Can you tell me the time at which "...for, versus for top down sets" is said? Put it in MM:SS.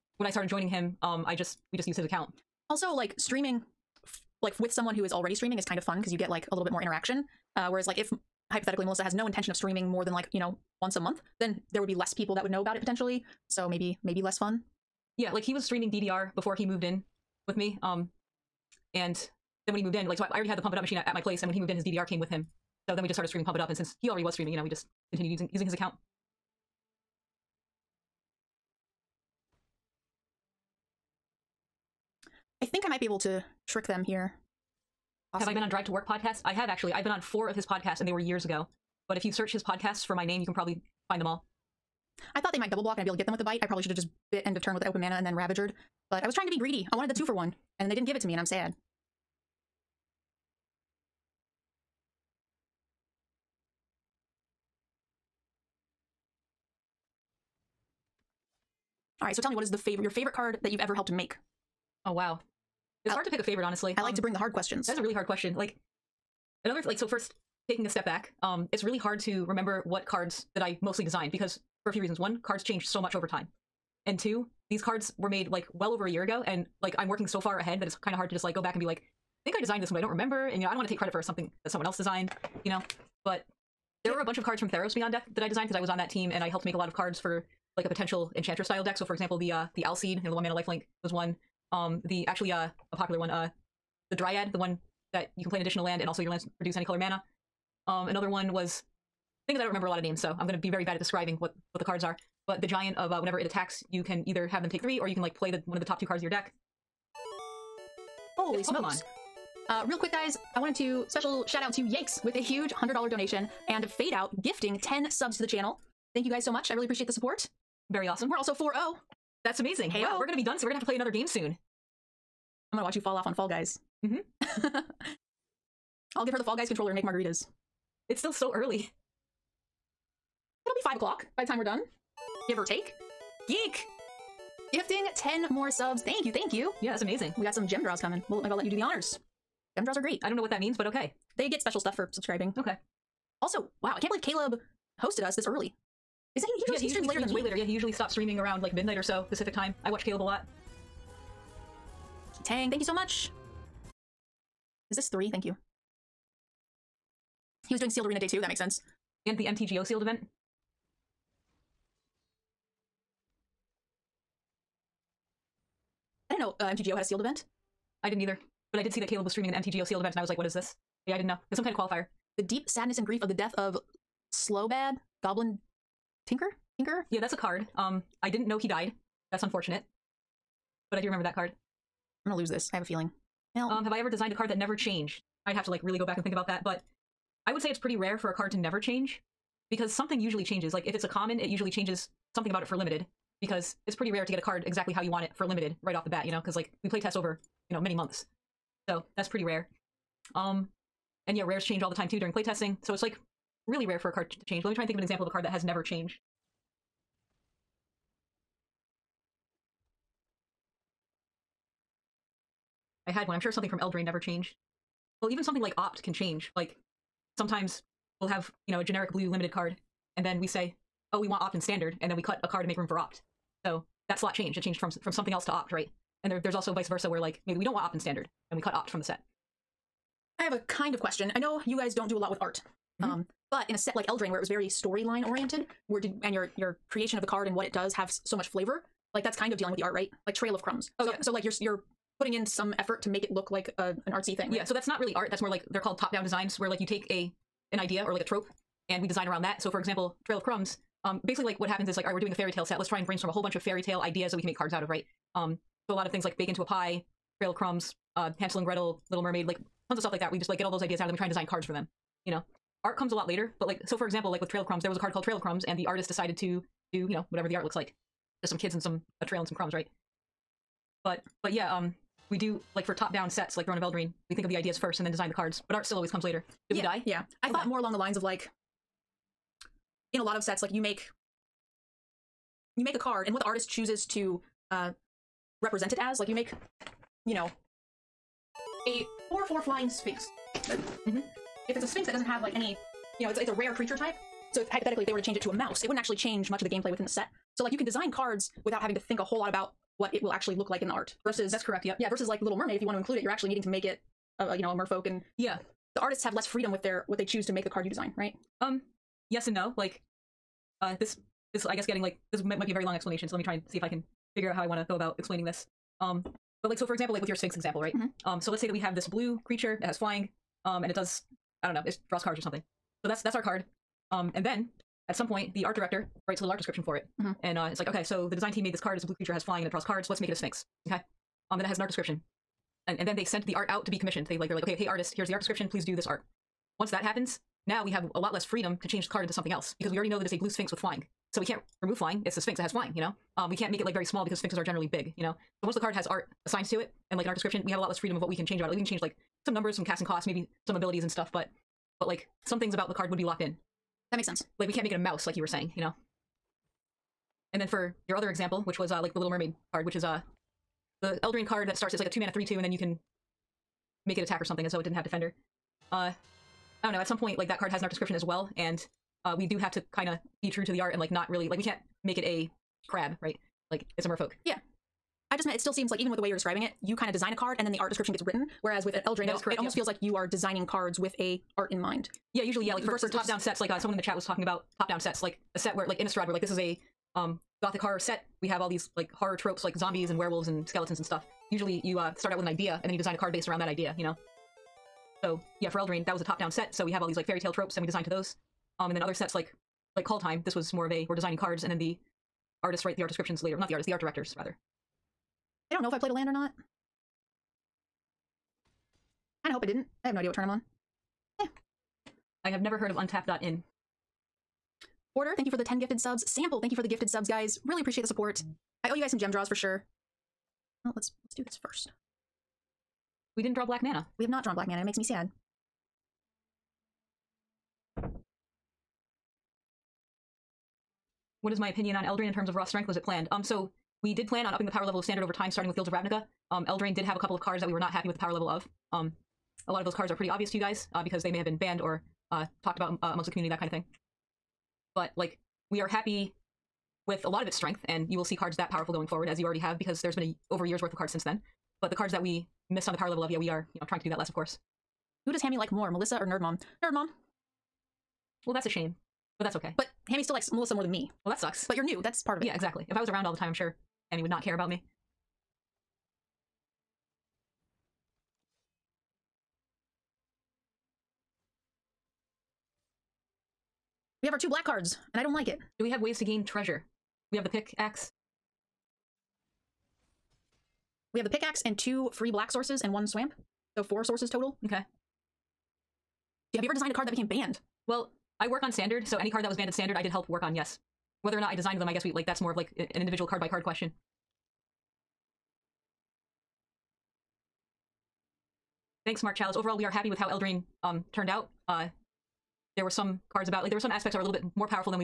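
06:22.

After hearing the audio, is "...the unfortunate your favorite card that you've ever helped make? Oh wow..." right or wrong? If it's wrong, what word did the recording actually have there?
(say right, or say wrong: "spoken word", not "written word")
wrong: "favorite", not "unfortunate".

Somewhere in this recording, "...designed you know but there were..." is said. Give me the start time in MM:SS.
01:21.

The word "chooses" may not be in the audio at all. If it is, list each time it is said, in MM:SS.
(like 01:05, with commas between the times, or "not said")
04:43, 05:07.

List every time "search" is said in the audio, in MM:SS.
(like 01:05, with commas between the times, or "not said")
00:39.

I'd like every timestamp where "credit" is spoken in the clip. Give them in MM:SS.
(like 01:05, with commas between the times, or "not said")
01:20.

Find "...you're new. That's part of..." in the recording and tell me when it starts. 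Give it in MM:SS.
07:41.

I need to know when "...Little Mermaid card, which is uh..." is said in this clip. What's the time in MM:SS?
05:59.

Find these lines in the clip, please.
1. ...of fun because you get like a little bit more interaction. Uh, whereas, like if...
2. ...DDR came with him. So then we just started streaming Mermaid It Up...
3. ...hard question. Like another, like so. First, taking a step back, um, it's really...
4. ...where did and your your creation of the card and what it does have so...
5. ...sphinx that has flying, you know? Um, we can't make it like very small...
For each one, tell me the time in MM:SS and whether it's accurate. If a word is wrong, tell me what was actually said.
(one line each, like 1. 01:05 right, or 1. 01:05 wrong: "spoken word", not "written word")
1. 00:05 right
2. 00:21 wrong: "Pump", not "Mermaid"
3. 01:05 right
4. 03:55 right
5. 05:42 right.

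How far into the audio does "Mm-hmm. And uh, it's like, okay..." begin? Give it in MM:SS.
05:27.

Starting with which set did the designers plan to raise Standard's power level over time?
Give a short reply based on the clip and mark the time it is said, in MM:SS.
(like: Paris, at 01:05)
Guilds of Ravnica, at 07:15.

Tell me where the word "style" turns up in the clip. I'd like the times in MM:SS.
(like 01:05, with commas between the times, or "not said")
01:28.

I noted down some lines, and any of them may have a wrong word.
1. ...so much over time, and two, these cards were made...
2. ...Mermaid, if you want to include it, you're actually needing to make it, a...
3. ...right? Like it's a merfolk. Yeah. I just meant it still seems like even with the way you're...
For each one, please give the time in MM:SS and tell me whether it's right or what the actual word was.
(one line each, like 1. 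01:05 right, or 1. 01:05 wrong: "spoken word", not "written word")
1. 01:12 right
2. 05:02 right
3. 06:13 right.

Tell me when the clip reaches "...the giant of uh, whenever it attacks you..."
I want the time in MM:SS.
01:42.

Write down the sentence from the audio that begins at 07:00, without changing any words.
Well, let's let's do this first.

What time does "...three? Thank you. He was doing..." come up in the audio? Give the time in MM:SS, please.
02:35.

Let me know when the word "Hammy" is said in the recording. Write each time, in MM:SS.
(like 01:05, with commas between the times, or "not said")
07:35, 07:40, 07:44.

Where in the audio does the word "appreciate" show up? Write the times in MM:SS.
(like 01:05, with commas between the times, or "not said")
01:56, 06:57.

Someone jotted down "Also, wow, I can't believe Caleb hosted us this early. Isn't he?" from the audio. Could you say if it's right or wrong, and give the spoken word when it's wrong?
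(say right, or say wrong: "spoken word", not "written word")
right.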